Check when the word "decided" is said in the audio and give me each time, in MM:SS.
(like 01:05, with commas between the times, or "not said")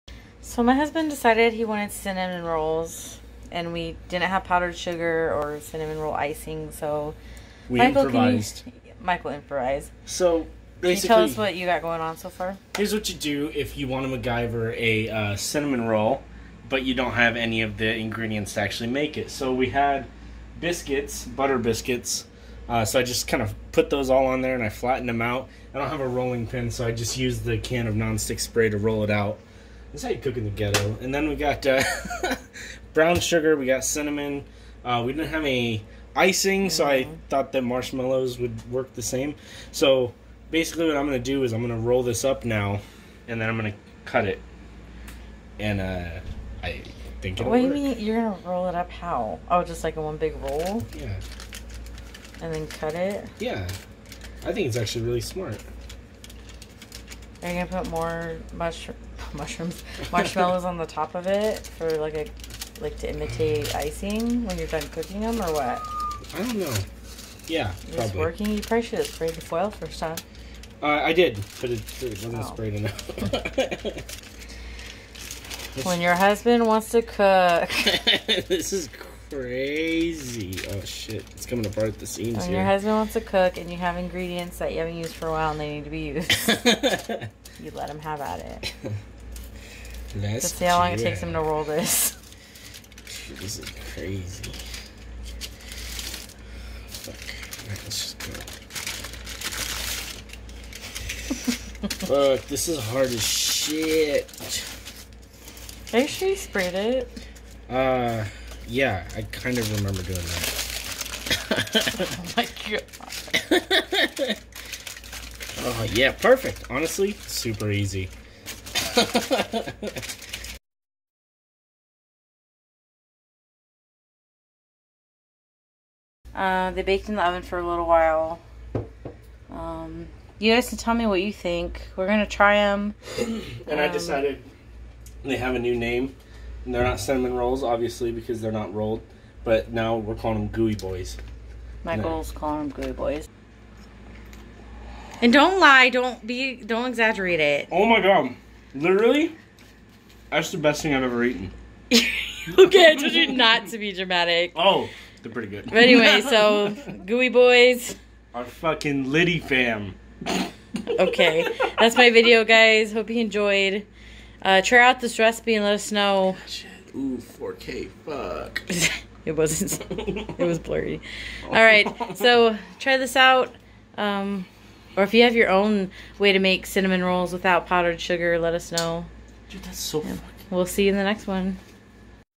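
00:01, 02:13.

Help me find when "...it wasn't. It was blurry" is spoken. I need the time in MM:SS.
02:49.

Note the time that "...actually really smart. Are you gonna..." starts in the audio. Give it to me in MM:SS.
00:54.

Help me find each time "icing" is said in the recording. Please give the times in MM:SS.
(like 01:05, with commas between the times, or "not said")
00:06, 00:36, 01:03.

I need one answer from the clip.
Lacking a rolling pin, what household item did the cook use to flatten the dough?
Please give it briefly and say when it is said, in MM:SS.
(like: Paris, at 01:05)
can of nonstick spray, at 00:27.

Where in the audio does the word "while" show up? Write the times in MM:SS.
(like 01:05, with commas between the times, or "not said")
01:25, 02:07.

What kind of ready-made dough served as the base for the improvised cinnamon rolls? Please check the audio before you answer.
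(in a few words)
butter biscuits.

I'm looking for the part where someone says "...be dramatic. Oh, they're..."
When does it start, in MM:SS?
02:33.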